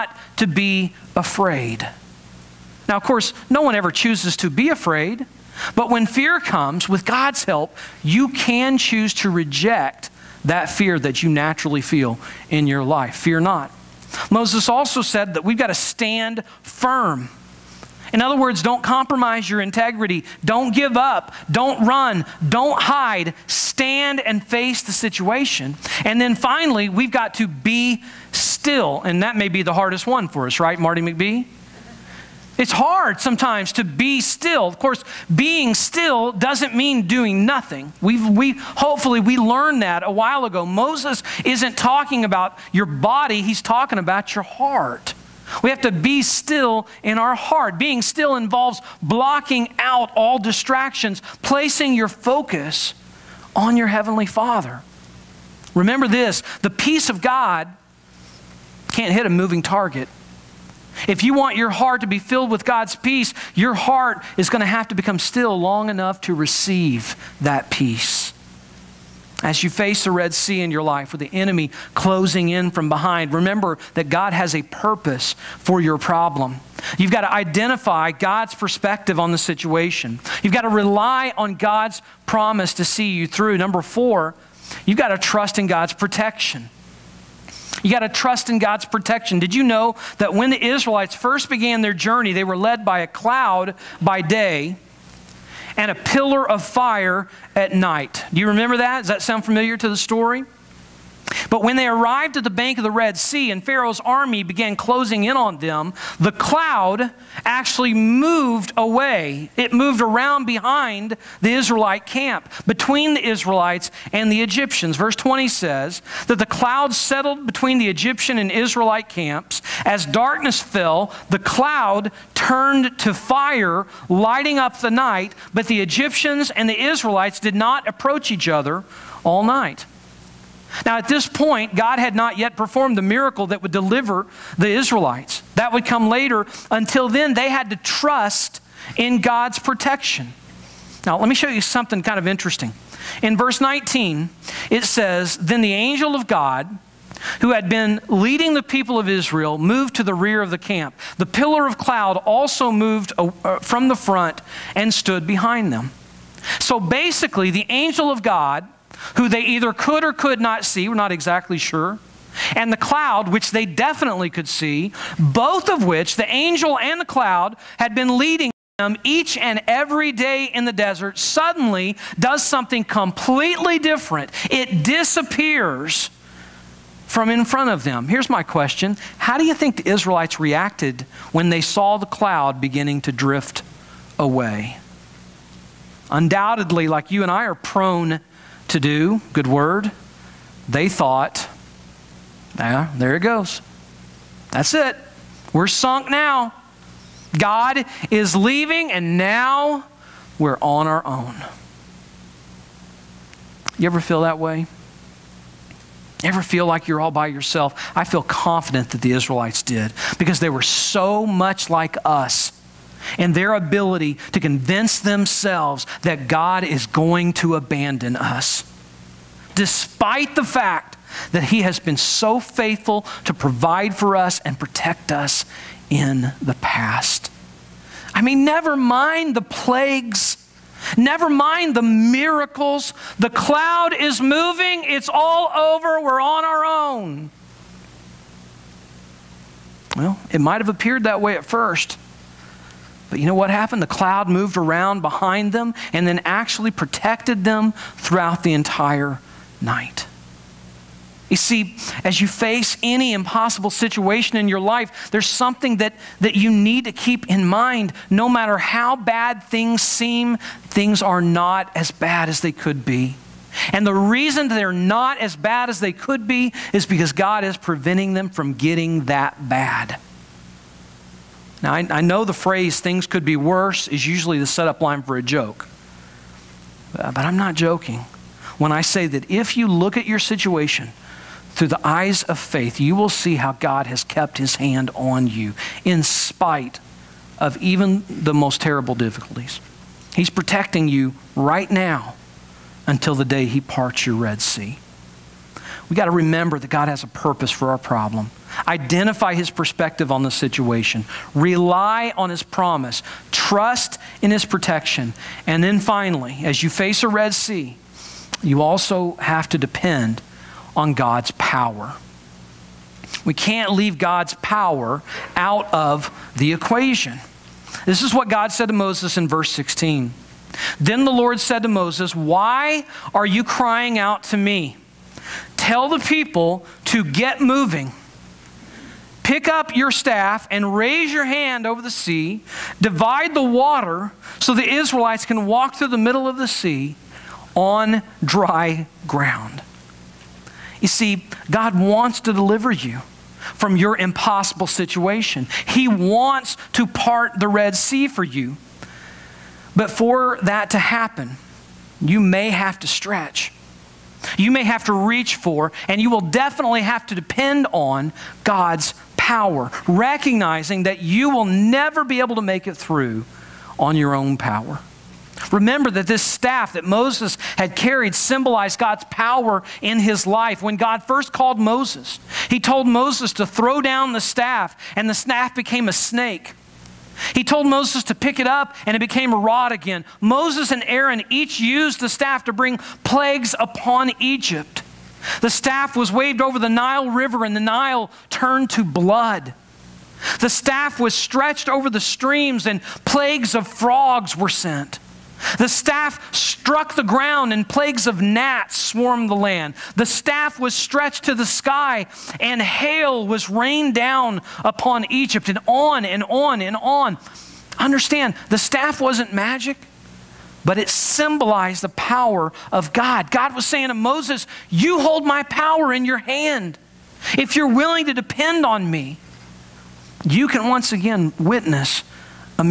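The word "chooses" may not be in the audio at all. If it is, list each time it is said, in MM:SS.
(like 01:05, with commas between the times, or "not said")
00:03, 00:08.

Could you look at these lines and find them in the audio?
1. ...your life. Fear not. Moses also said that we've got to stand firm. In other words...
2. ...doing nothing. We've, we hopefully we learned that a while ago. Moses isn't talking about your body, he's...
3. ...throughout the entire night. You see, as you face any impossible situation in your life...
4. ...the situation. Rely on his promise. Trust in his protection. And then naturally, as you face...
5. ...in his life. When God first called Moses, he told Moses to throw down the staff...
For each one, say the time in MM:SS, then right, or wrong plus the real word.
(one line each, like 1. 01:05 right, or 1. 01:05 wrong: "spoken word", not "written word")
1. 00:12 right
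2. 00:37 right
3. 04:07 right
4. 05:00 wrong: "finally", not "naturally"
5. 06:09 right.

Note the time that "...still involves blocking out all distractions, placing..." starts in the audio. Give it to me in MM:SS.
00:48.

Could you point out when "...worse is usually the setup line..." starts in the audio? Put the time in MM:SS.
04:33.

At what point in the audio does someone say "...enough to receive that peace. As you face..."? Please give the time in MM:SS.
01:05.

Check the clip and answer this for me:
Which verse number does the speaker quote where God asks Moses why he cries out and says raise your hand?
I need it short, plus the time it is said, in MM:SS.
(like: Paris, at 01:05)
16, at 05:19.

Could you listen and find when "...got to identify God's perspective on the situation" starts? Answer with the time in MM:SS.
01:17.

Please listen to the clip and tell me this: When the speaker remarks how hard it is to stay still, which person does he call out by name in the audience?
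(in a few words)
Marty McBee.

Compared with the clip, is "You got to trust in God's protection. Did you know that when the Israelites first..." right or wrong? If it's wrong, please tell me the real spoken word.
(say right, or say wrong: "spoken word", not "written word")
right.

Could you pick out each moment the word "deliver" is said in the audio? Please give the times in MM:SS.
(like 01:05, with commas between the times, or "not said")
02:13, 05:42.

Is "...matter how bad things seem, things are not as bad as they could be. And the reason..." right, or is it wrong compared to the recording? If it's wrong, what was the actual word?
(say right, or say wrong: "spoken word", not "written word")
right.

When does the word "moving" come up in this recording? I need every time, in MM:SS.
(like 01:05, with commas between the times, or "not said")
00:59, 03:54, 05:27.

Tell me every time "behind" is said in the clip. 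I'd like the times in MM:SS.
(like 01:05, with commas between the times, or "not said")
01:12, 01:50, 02:35, 04:05.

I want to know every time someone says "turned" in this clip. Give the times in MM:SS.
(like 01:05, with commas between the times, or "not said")
02:02, 06:28.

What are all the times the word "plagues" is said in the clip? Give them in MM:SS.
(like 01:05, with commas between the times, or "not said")
03:49, 06:23, 06:33, 06:37.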